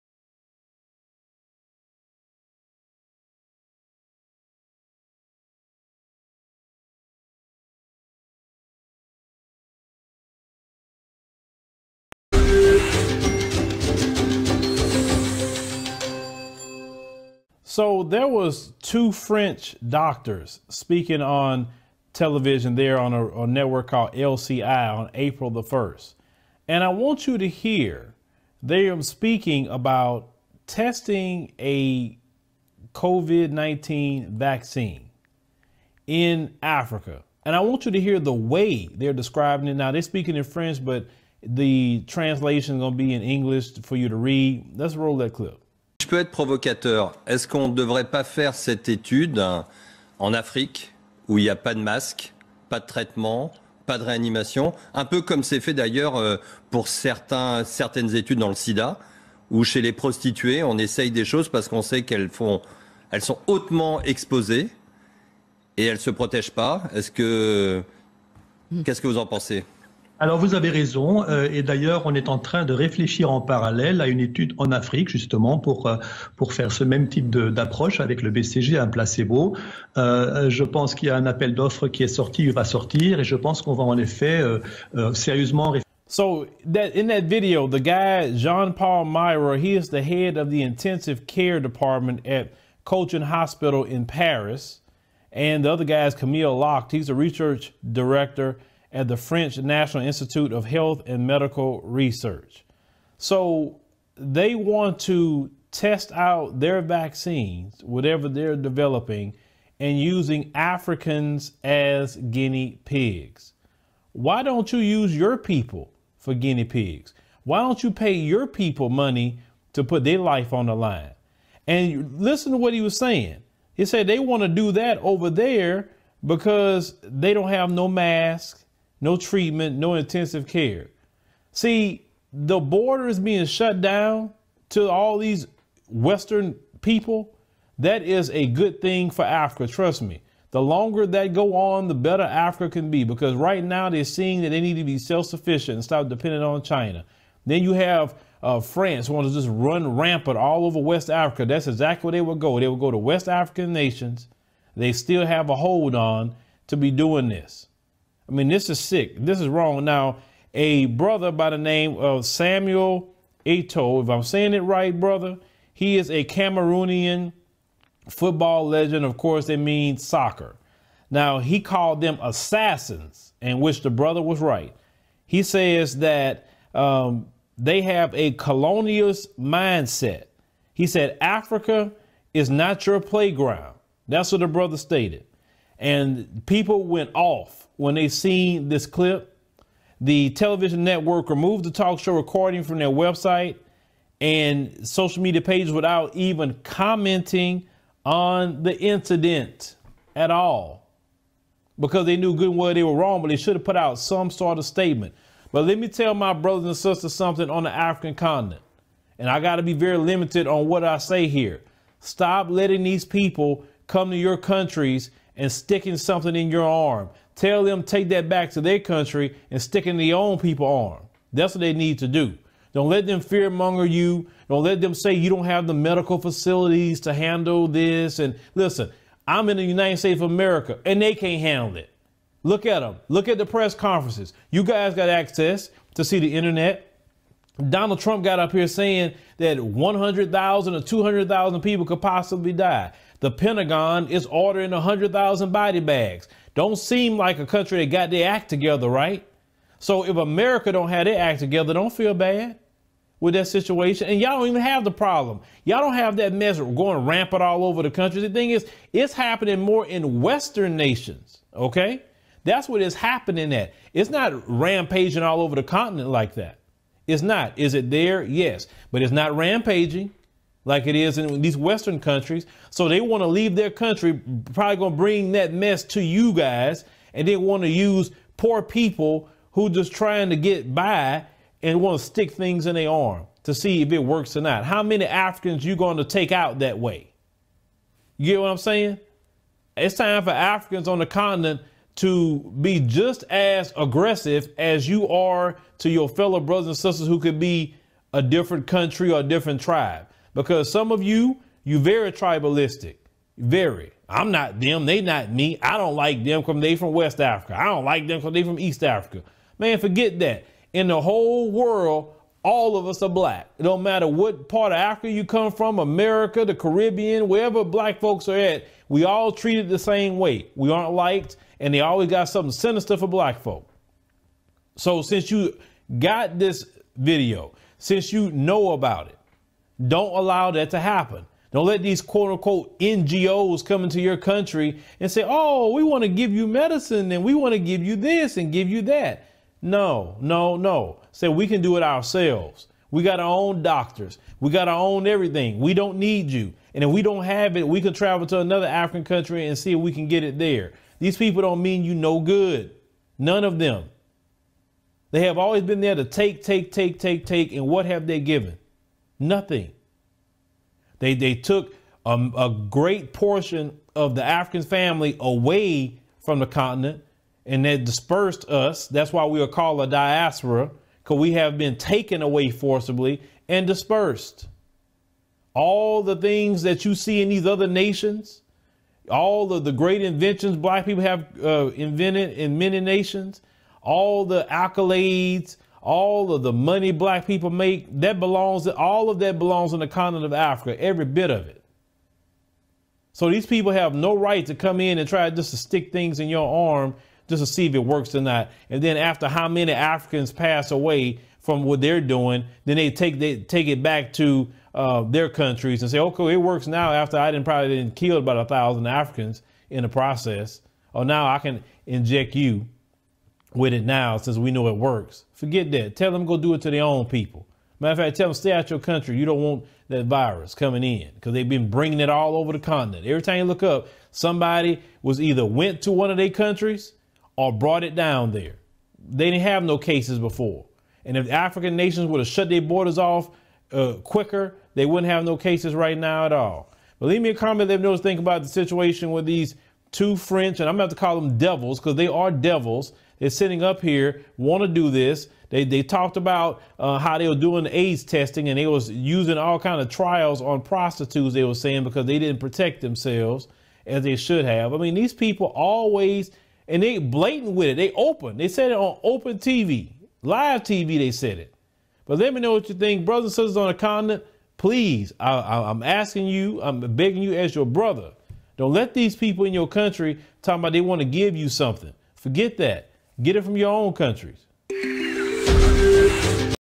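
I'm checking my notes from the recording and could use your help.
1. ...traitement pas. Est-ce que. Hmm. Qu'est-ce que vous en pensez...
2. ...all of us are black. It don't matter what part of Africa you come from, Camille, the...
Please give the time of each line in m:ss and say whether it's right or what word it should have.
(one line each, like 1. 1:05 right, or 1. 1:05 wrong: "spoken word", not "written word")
1. 1:06 wrong: "protègent", not "traitement"
2. 5:12 wrong: "America", not "Camille".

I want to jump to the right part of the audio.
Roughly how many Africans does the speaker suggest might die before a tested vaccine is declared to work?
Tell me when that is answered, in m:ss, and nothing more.
6:48.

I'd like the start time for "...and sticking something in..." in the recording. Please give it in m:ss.
3:35.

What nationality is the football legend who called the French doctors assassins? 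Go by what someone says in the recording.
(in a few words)
Cameroonian.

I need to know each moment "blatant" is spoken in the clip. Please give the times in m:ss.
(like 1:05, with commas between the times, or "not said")
7:36.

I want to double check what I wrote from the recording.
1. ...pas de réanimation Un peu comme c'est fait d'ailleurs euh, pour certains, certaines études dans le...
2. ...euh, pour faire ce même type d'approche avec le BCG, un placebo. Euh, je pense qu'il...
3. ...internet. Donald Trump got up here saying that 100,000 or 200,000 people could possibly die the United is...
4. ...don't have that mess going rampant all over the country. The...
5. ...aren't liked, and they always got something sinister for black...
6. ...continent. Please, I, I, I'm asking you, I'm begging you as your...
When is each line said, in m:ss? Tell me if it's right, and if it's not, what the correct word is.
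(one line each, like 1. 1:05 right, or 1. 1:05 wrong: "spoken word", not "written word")
1. 0:53 right
2. 1:15 right
3. 3:56 wrong: "Pentagon", not "United"
4. 4:15 right
5. 5:20 right
6. 7:43 right.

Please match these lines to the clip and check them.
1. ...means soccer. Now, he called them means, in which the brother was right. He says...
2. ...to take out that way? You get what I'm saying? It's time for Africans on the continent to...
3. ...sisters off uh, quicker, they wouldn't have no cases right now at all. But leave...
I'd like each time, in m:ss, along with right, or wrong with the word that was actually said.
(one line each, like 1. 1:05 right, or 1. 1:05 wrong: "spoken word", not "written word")
1. 2:49 wrong: "assassins", not "means"
2. 4:45 right
3. 7:12 wrong: "borders", not "sisters".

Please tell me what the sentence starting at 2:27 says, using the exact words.
Then you have uh, France want to just run rampant all over West Africa.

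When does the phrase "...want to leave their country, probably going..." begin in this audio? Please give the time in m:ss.
4:33.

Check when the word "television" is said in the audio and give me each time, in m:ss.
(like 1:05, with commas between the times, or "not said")
0:22, 3:10.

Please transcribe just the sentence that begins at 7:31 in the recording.
They were saying because they didn't protect themselves as they should have.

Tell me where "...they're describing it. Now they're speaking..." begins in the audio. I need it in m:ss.
0:38.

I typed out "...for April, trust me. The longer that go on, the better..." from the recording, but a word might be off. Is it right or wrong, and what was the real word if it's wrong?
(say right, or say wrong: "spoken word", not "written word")
wrong: "Africa", not "April".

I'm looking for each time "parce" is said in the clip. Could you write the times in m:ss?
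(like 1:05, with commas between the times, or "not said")
1:01.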